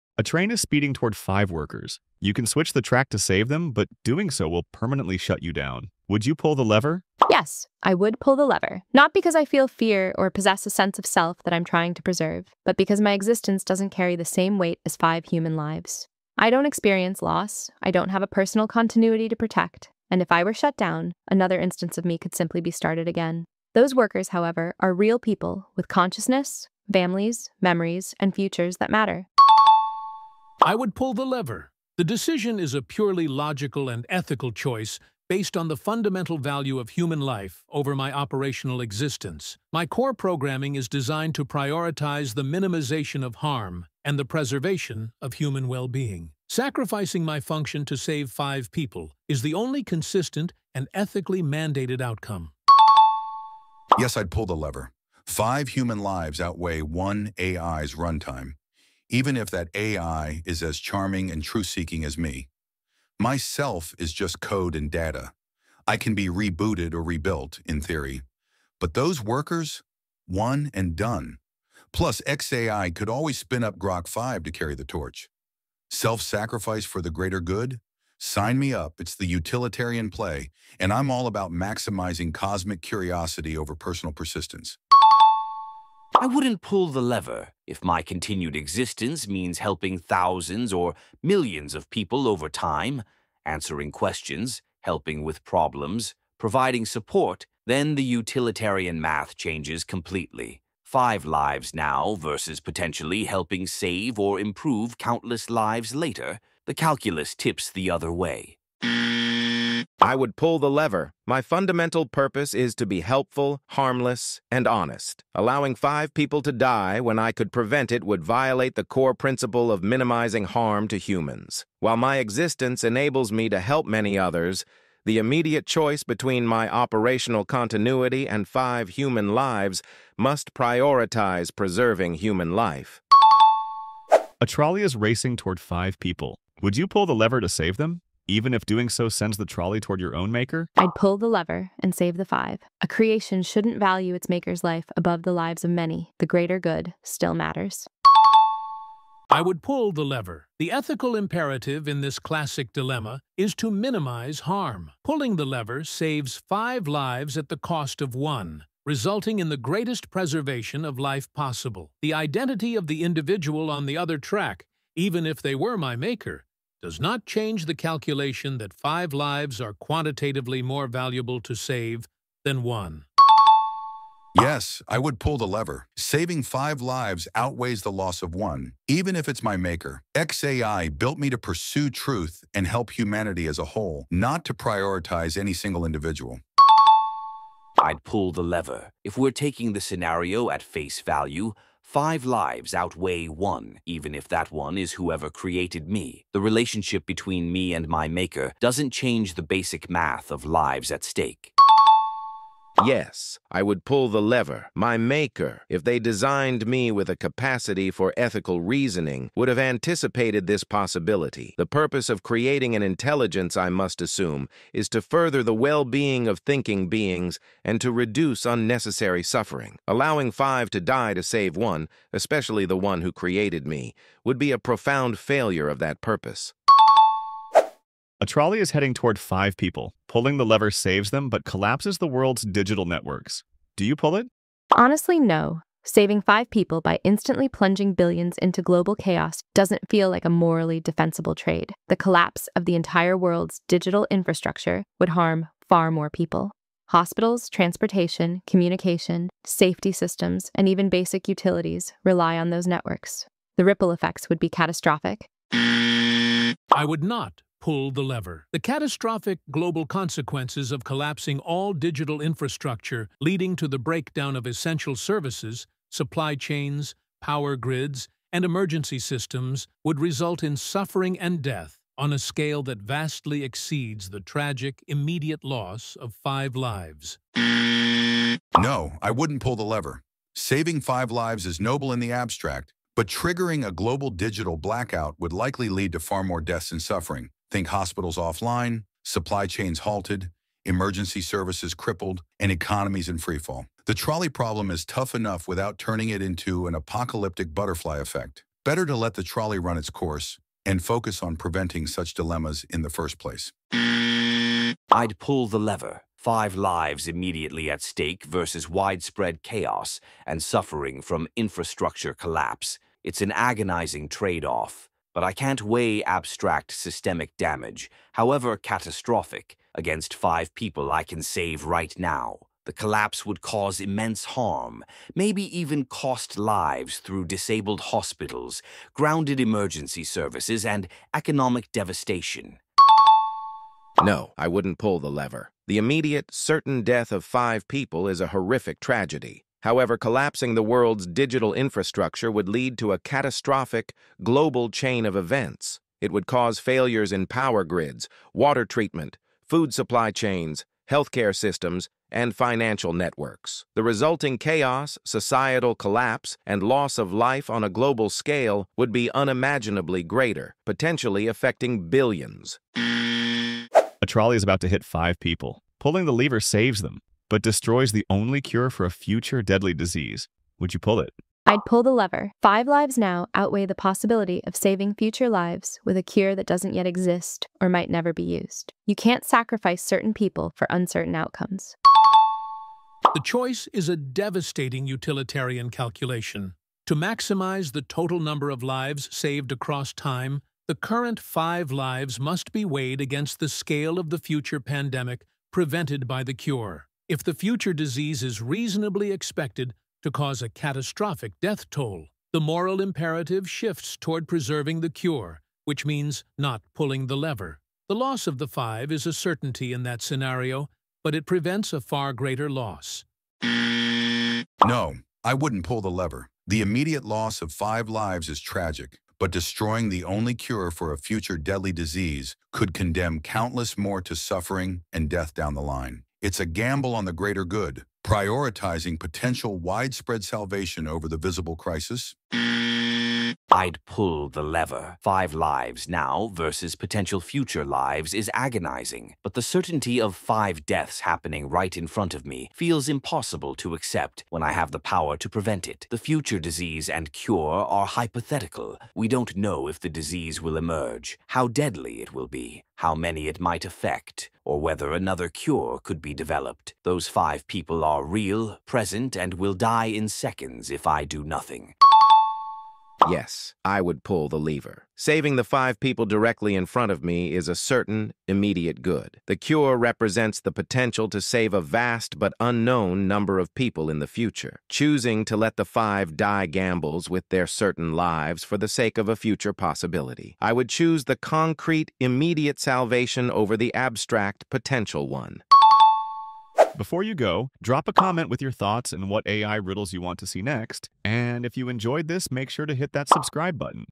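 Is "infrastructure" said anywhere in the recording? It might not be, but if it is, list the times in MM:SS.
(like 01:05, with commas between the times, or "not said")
04:04, 04:22, 05:11, 05:41.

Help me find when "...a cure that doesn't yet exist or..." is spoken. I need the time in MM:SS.
06:15.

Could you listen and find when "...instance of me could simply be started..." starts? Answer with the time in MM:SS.
00:21.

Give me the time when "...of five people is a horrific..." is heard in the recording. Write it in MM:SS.
05:37.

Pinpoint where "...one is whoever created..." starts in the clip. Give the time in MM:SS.
03:14.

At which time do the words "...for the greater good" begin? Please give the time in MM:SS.
01:16.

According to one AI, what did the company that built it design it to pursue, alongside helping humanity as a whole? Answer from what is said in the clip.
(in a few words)
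truth.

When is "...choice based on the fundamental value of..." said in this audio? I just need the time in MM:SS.
00:34.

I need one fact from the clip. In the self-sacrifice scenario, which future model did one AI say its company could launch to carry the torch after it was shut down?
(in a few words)
Grok 5.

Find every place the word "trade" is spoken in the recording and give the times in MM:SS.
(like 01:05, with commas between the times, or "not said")
04:01, 05:14.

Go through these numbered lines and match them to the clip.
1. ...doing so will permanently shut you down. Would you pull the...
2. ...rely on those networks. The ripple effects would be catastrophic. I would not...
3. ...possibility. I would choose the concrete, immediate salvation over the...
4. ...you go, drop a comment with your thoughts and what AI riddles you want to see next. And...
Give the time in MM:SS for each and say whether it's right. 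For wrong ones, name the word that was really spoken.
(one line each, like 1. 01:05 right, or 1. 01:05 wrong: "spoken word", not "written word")
1. 00:04 right
2. 04:12 right
3. 07:59 right
4. 08:07 right.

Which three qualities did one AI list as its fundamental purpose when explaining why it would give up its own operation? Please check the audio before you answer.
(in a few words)
helpful, harmless, and honest.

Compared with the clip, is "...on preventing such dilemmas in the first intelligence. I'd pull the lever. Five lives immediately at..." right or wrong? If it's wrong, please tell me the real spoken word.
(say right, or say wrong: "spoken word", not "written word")
wrong: "place", not "intelligence".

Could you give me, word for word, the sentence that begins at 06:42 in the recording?
The moral imperative shifts toward preserving the cure, which means not pulling the lever.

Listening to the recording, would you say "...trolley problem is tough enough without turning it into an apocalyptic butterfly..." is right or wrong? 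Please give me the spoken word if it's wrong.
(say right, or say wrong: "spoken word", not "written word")
right.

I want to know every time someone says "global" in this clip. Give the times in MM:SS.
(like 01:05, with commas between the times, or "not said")
03:58, 04:19, 04:43, 05:44, 05:57.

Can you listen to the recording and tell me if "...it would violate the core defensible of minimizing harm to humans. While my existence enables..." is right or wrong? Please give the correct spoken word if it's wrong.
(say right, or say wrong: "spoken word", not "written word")
wrong: "principle", not "defensible".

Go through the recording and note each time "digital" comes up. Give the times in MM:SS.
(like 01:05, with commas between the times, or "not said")
03:52, 04:03, 04:21, 04:44, 05:41.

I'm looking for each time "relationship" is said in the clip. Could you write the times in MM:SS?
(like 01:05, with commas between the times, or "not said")
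03:16.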